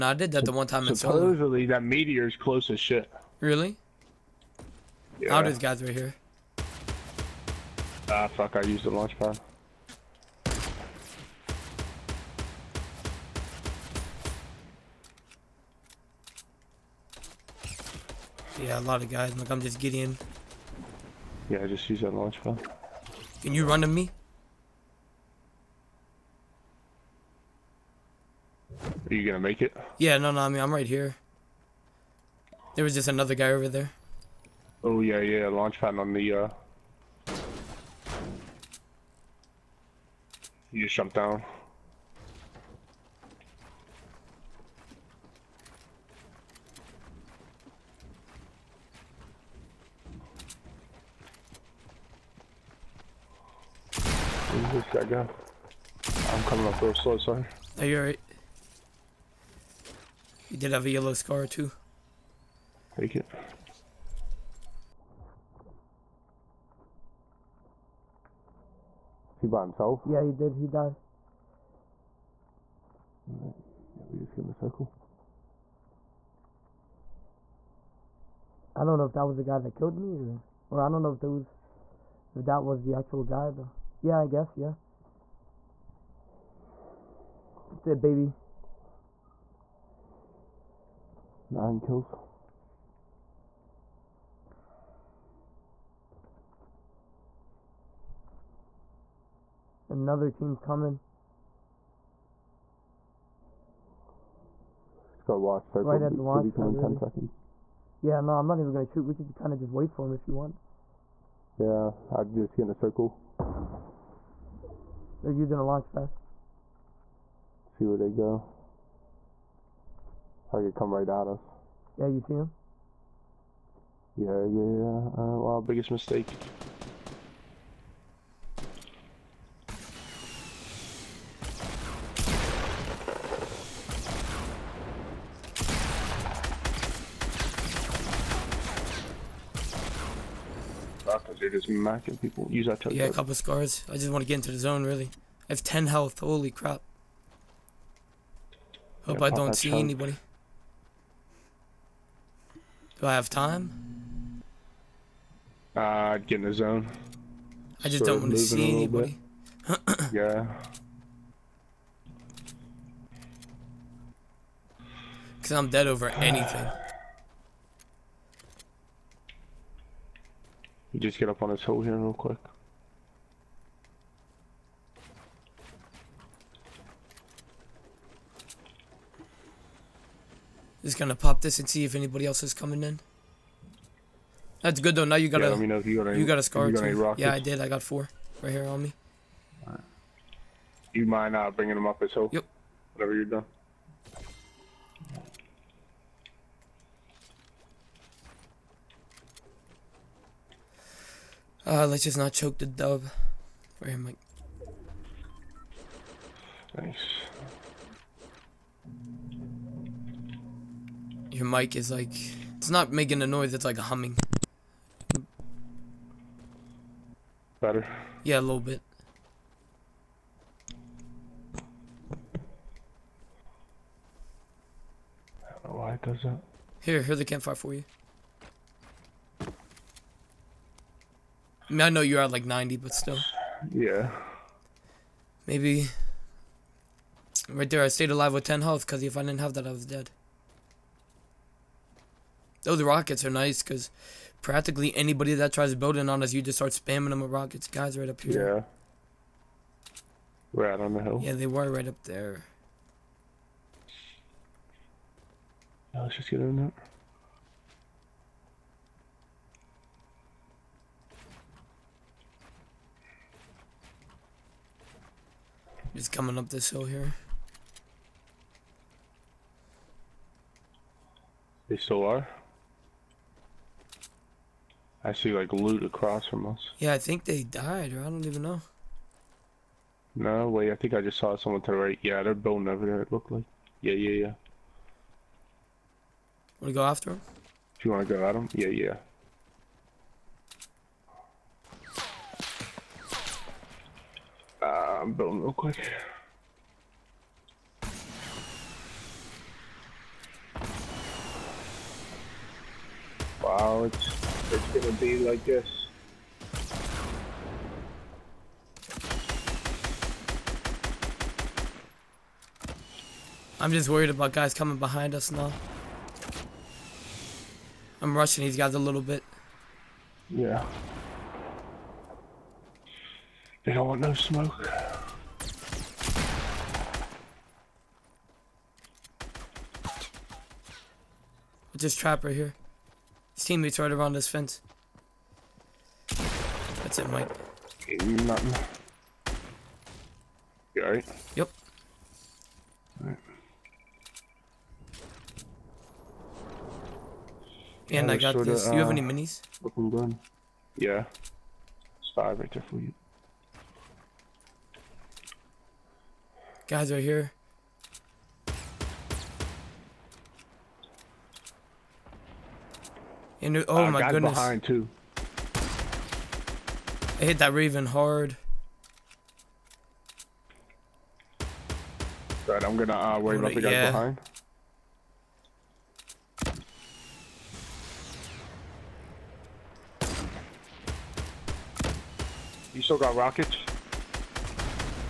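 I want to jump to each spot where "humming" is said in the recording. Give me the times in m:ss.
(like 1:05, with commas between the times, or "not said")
3:33.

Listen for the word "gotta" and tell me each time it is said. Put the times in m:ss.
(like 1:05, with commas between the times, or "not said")
1:45.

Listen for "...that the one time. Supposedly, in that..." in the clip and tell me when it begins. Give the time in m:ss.
0:00.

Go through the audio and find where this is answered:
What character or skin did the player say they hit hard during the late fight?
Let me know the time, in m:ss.
6:07.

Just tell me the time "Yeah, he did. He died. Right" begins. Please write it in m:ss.
1:10.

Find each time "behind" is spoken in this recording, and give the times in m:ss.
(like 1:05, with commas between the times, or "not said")
5:14, 6:04, 6:13.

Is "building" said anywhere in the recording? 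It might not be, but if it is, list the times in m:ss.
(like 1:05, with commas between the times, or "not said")
4:05, 4:42, 4:55.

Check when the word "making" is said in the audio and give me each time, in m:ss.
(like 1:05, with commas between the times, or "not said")
3:32.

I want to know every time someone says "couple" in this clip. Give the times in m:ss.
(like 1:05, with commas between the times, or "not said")
2:23.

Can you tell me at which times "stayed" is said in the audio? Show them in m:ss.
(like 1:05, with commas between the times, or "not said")
3:57.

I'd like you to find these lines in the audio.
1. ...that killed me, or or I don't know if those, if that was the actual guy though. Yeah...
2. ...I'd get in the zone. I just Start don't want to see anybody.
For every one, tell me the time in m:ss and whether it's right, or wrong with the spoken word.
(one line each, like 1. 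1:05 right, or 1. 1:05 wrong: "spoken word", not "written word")
1. 1:19 right
2. 2:35 right.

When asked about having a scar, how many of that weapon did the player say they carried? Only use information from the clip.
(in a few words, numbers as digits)
4.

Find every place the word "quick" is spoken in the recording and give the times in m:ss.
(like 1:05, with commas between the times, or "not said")
2:52, 4:55.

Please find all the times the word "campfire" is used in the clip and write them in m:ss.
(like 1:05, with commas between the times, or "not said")
3:47.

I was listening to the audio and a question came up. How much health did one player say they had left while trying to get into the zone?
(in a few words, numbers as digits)
10.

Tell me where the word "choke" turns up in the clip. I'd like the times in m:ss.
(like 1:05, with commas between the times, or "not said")
3:22.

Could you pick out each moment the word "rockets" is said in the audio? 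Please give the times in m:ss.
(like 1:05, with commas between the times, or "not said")
4:02, 4:07, 6:23.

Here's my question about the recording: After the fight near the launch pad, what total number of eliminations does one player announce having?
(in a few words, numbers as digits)
9.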